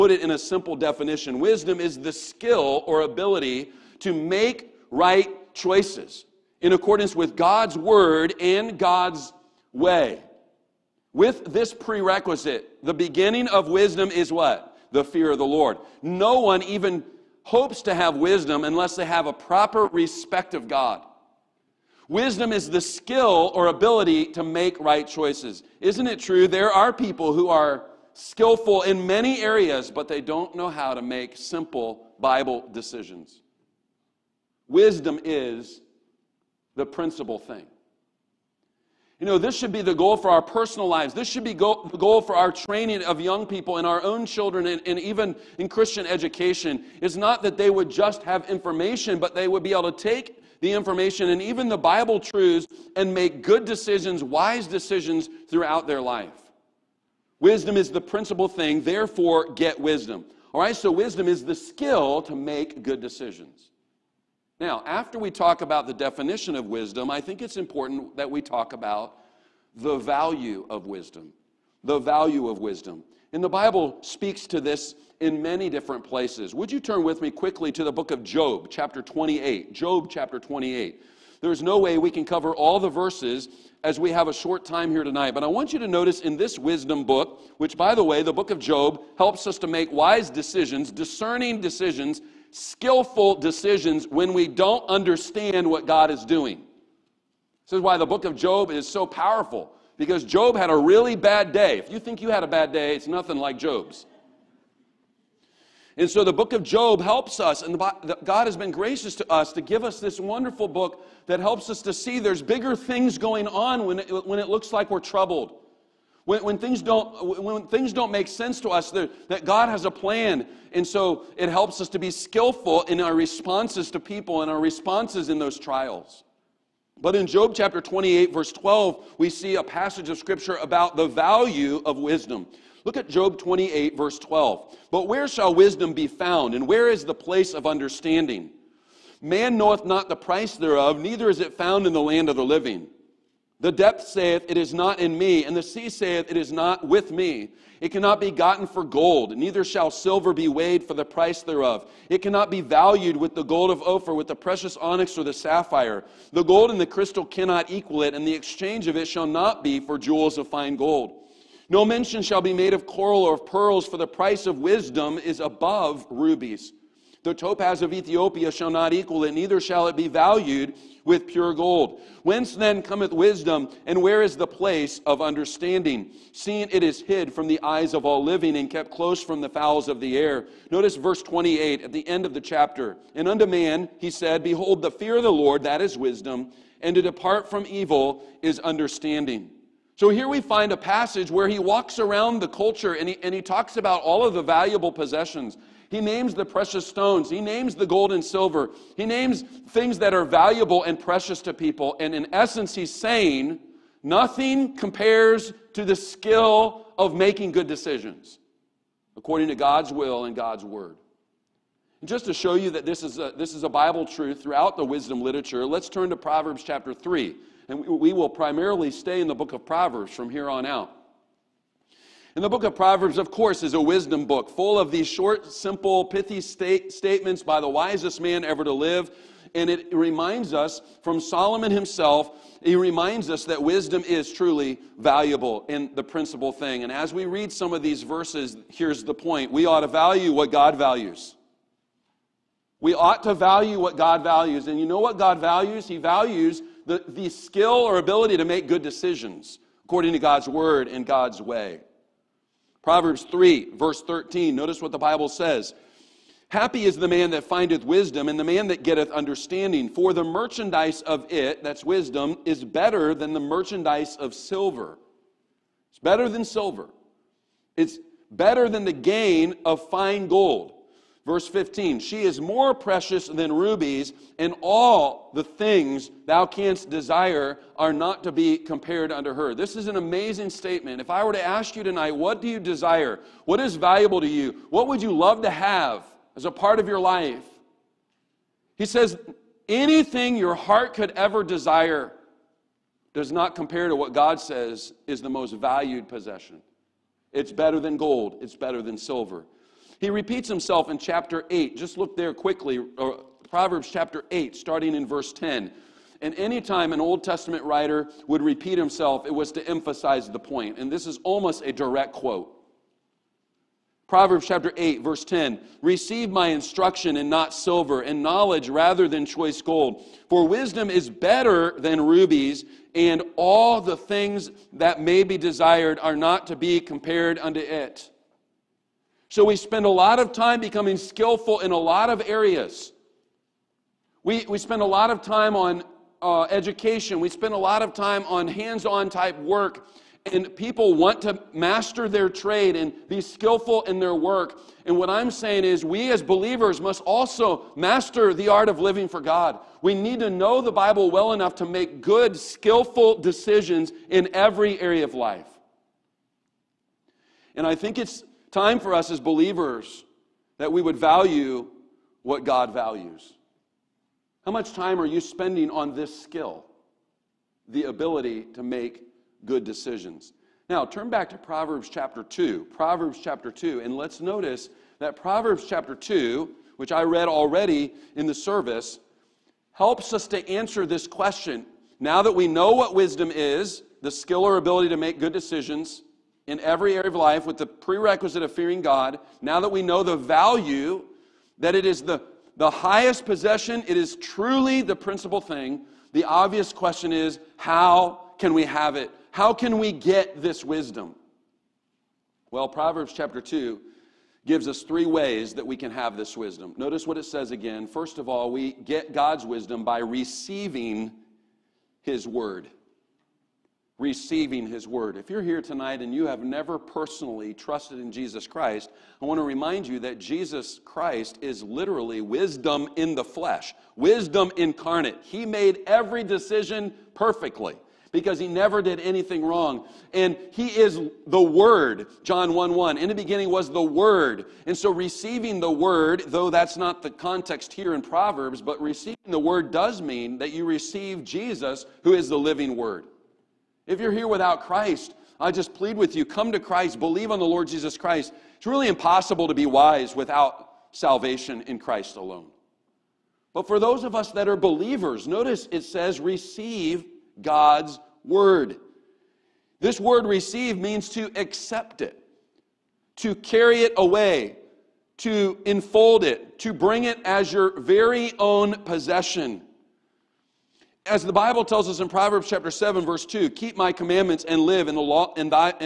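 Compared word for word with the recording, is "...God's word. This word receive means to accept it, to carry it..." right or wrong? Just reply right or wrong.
right.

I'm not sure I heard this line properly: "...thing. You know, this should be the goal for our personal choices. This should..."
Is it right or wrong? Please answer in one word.
wrong.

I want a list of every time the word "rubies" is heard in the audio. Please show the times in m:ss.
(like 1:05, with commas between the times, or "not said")
2:46, 4:33, 5:22.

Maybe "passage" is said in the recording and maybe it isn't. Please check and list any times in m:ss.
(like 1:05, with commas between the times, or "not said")
2:09, 3:10.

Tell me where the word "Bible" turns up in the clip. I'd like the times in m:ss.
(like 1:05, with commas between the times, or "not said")
0:32, 0:51, 1:13, 3:33, 4:14, 5:50, 7:51.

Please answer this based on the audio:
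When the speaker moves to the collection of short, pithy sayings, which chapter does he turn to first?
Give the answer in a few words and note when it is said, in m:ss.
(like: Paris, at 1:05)
Chapter 3, at 3:36.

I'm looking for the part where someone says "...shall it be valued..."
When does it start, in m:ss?
2:49.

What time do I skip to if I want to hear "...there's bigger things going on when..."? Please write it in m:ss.
1:52.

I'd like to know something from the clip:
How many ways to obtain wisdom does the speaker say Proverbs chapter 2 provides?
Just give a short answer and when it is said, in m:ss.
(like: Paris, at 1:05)
3, at 6:44.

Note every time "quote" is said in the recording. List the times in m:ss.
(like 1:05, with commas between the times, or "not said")
5:12.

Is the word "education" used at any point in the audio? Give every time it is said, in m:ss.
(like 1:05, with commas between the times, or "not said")
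0:46, 5:36.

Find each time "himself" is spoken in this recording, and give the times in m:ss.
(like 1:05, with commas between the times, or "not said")
3:51, 5:00, 5:08.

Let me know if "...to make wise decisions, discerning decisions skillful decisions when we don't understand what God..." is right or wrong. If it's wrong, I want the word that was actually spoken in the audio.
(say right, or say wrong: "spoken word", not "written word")
right.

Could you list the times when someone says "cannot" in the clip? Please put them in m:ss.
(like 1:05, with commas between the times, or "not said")
2:27, 2:32, 2:37.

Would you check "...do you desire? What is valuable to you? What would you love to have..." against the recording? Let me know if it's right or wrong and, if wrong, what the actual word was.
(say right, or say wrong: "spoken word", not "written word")
right.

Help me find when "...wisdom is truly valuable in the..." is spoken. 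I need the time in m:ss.
3:53.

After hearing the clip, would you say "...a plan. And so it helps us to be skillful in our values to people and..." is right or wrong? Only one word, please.
wrong.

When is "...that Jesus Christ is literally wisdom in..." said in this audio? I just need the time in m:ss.
6:59.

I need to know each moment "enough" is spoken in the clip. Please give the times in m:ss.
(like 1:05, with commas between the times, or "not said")
5:51.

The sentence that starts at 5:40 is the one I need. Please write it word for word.
And people want to master their trade and be skillful in their work.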